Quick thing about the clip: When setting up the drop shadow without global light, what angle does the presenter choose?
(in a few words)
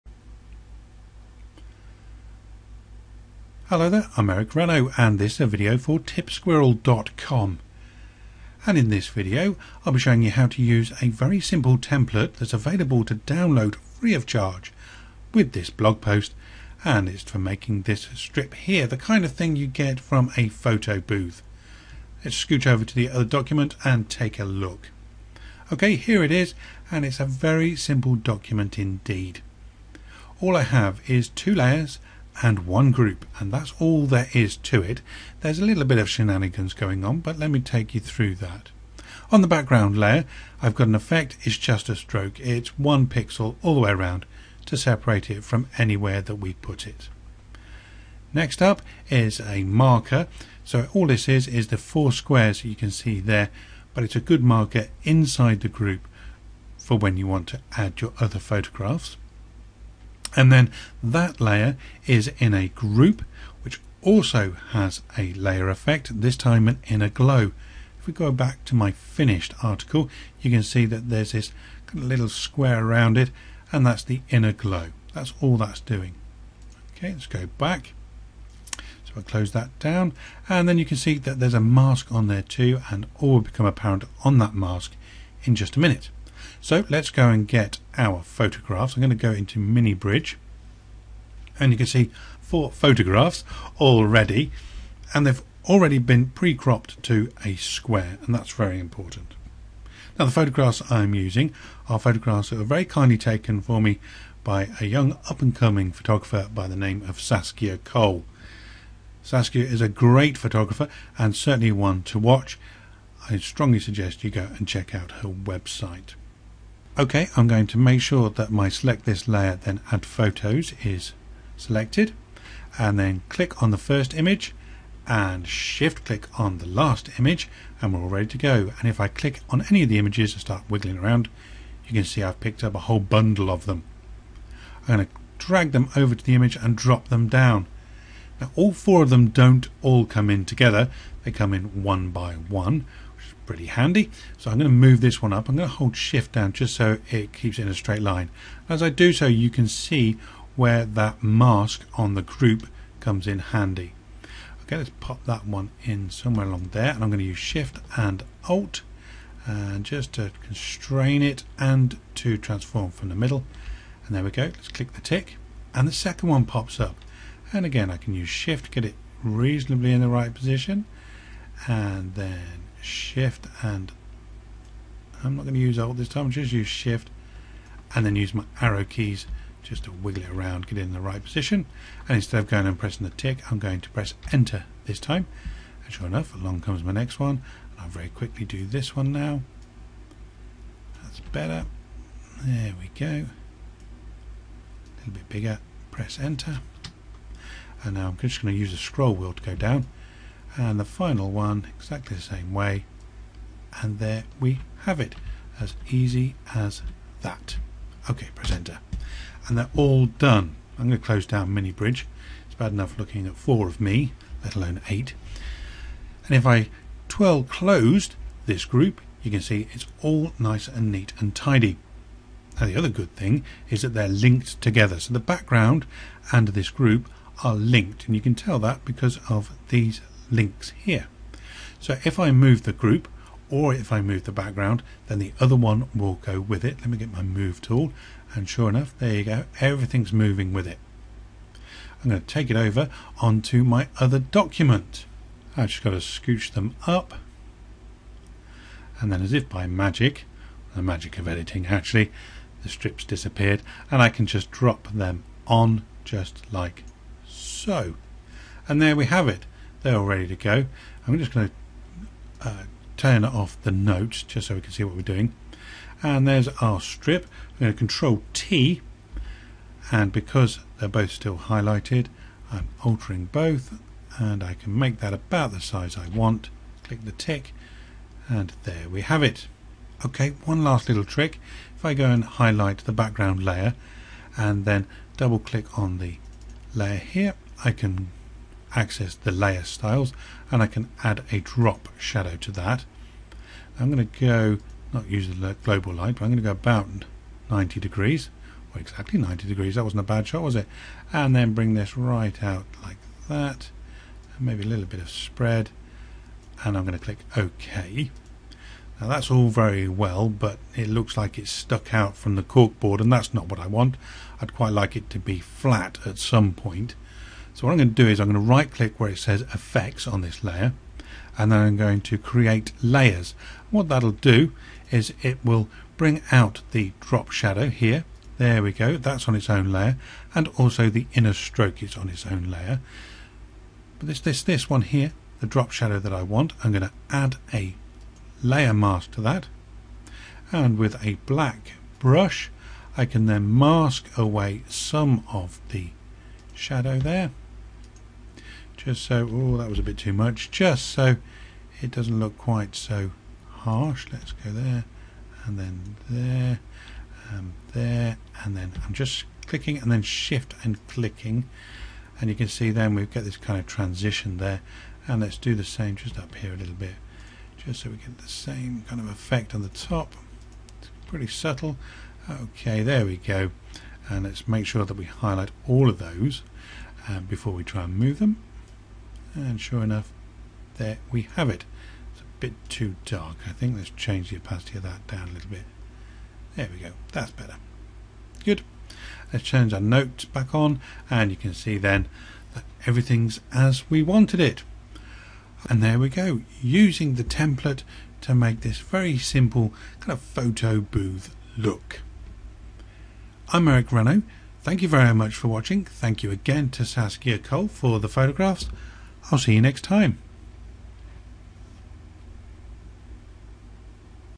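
90 degrees.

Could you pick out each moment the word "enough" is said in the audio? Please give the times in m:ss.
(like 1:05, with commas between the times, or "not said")
3:06, 3:32, 3:58, 6:19.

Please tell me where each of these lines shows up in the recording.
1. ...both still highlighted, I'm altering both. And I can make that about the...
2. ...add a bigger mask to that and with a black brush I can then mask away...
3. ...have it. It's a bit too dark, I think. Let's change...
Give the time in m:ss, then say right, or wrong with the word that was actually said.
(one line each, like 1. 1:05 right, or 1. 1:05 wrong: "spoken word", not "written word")
1. 4:30 right
2. 5:37 wrong: "layer", not "bigger"
3. 6:21 right.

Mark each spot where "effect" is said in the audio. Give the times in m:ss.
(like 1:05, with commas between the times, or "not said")
0:40, 1:05, 5:19, 6:09.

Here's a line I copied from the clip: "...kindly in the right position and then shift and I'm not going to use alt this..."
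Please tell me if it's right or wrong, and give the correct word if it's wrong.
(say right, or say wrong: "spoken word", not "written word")
wrong: "reasonably", not "kindly".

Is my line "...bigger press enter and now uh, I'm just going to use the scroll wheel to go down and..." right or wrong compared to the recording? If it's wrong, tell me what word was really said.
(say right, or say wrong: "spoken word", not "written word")
right.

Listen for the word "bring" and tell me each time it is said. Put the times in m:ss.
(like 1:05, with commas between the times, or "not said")
5:01, 5:25.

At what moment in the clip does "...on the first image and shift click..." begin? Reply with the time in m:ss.
2:03.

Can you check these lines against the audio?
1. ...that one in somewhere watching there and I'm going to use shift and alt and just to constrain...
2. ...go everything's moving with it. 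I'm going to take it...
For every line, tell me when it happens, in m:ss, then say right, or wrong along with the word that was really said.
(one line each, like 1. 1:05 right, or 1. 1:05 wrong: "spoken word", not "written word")
1. 2:35 wrong: "along", not "watching"
2. 3:59 right.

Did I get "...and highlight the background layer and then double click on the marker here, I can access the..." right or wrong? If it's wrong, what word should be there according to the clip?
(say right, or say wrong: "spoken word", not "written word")
wrong: "layer", not "marker".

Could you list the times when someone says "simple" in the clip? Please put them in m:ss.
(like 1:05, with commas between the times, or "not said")
0:11, 0:27, 6:39.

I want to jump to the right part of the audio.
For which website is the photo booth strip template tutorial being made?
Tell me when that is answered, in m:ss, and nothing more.
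0:05.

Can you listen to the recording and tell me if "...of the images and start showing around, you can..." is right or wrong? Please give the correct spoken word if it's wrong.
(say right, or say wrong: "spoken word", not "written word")
wrong: "wiggling", not "showing".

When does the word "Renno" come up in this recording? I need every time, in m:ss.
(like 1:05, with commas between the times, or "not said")
0:04, 6:43.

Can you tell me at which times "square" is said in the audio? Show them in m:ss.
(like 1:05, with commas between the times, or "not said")
0:52, 1:12, 1:37.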